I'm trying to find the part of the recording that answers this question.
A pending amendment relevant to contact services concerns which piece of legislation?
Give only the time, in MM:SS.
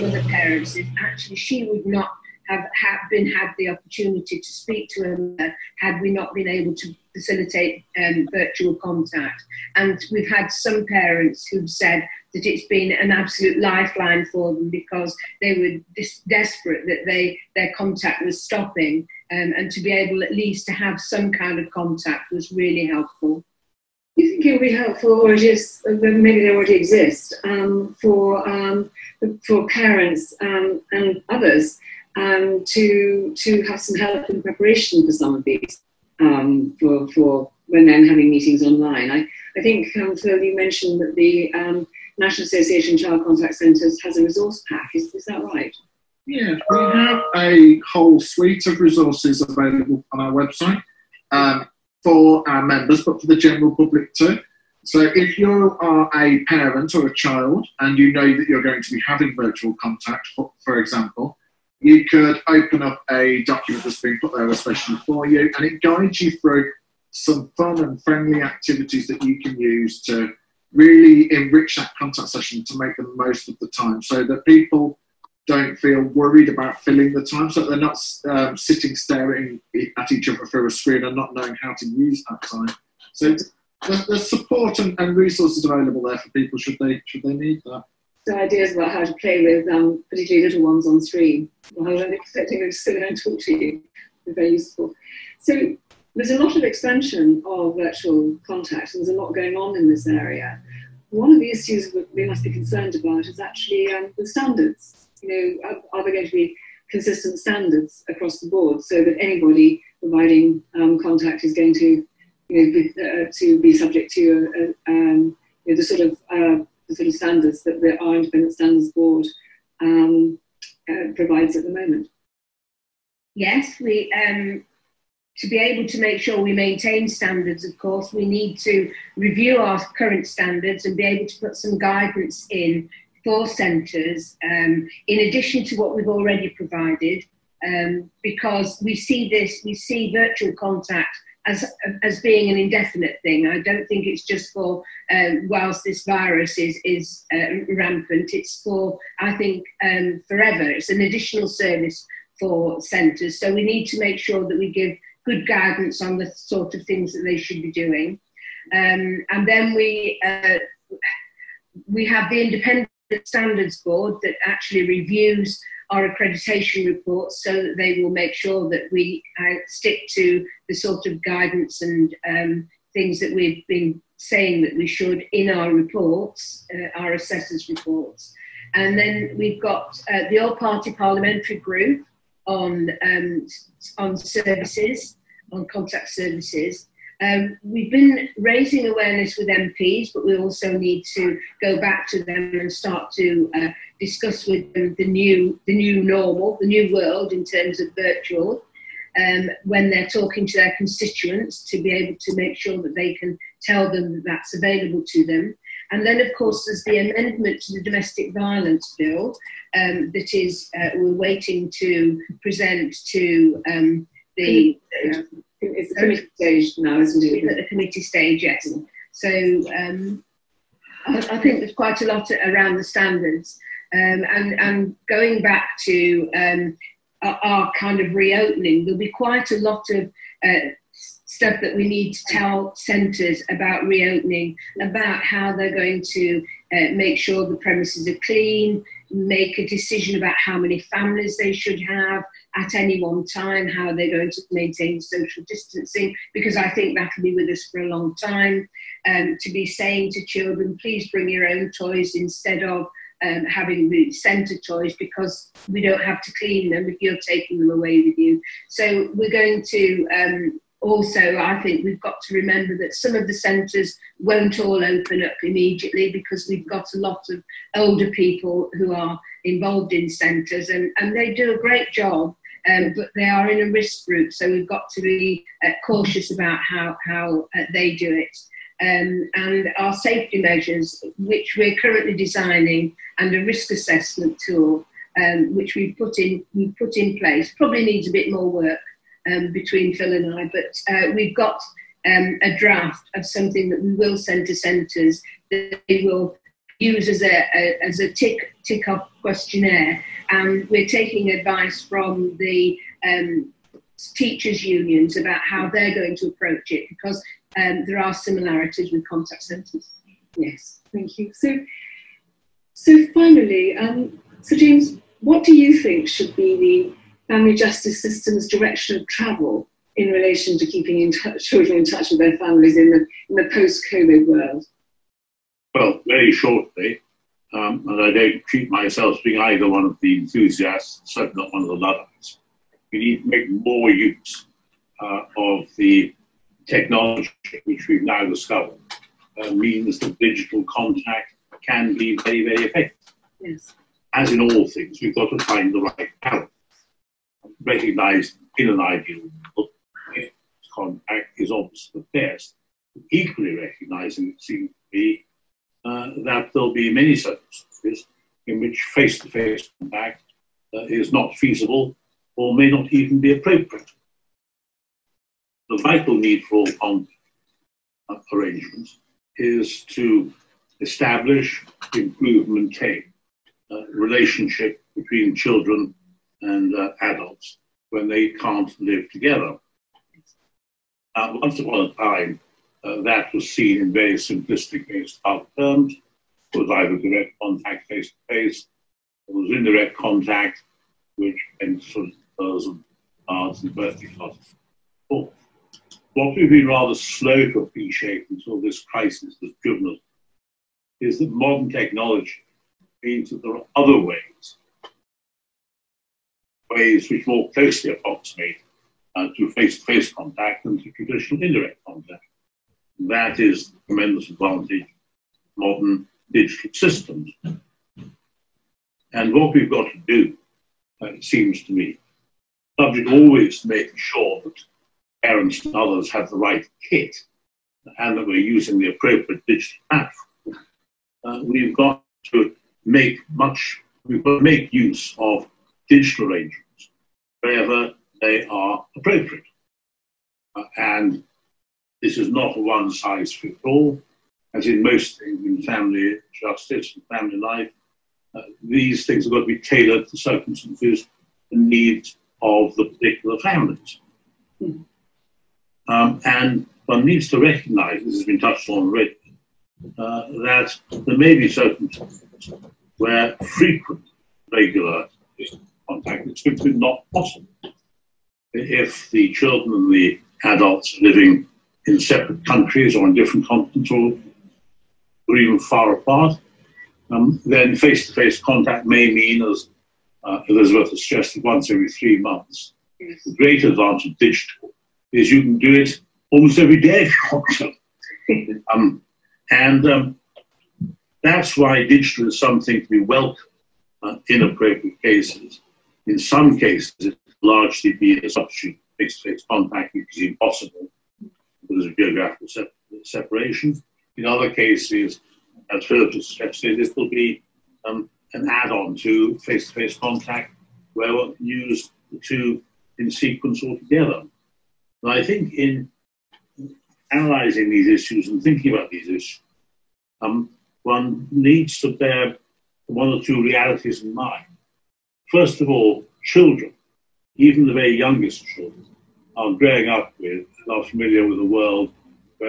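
03:27.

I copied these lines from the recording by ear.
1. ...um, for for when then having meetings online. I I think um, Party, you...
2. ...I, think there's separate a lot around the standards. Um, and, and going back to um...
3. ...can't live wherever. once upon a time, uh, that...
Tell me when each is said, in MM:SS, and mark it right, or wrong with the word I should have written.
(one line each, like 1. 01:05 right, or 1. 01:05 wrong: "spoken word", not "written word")
1. 00:36 wrong: "Phil", not "Party"
2. 03:41 wrong: "quite", not "separate"
3. 06:18 wrong: "together", not "wherever".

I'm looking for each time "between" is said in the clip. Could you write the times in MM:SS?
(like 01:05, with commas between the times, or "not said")
04:49, 06:14.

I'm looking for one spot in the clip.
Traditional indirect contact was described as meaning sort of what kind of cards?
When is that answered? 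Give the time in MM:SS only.
06:33.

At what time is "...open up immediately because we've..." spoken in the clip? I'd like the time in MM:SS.
04:24.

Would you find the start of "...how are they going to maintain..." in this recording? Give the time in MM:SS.
04:03.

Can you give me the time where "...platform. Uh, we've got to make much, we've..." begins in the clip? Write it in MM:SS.
07:09.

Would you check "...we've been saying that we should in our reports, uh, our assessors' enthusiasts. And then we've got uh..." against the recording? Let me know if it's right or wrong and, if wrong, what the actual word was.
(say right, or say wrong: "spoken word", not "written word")
wrong: "reports", not "enthusiasts".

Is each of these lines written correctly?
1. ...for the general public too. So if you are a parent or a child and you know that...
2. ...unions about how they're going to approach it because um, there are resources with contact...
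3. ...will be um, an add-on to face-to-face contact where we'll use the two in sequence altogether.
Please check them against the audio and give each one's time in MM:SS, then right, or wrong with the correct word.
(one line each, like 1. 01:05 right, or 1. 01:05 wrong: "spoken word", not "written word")
1. 00:53 right
2. 05:04 wrong: "similarities", not "resources"
3. 08:26 right.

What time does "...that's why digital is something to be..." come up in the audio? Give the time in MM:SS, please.
08:11.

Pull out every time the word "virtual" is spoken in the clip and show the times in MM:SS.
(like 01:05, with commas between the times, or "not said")
00:08, 00:59, 01:37, 02:20, 03:17.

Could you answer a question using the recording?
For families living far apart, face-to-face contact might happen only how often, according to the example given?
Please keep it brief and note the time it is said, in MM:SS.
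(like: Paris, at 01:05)
once every three months, at 08:01.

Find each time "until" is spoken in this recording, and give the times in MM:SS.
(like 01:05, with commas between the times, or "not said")
06:38.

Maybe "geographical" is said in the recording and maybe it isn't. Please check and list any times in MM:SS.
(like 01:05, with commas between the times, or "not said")
08:21.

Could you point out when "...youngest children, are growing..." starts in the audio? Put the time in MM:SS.
08:47.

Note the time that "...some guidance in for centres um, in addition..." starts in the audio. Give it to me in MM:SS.
02:11.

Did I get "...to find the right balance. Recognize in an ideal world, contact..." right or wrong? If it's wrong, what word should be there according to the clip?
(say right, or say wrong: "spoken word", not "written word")
right.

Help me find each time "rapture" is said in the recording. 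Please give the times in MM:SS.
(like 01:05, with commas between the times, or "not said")
not said.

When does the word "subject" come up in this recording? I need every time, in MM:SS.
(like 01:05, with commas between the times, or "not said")
01:53, 07:02.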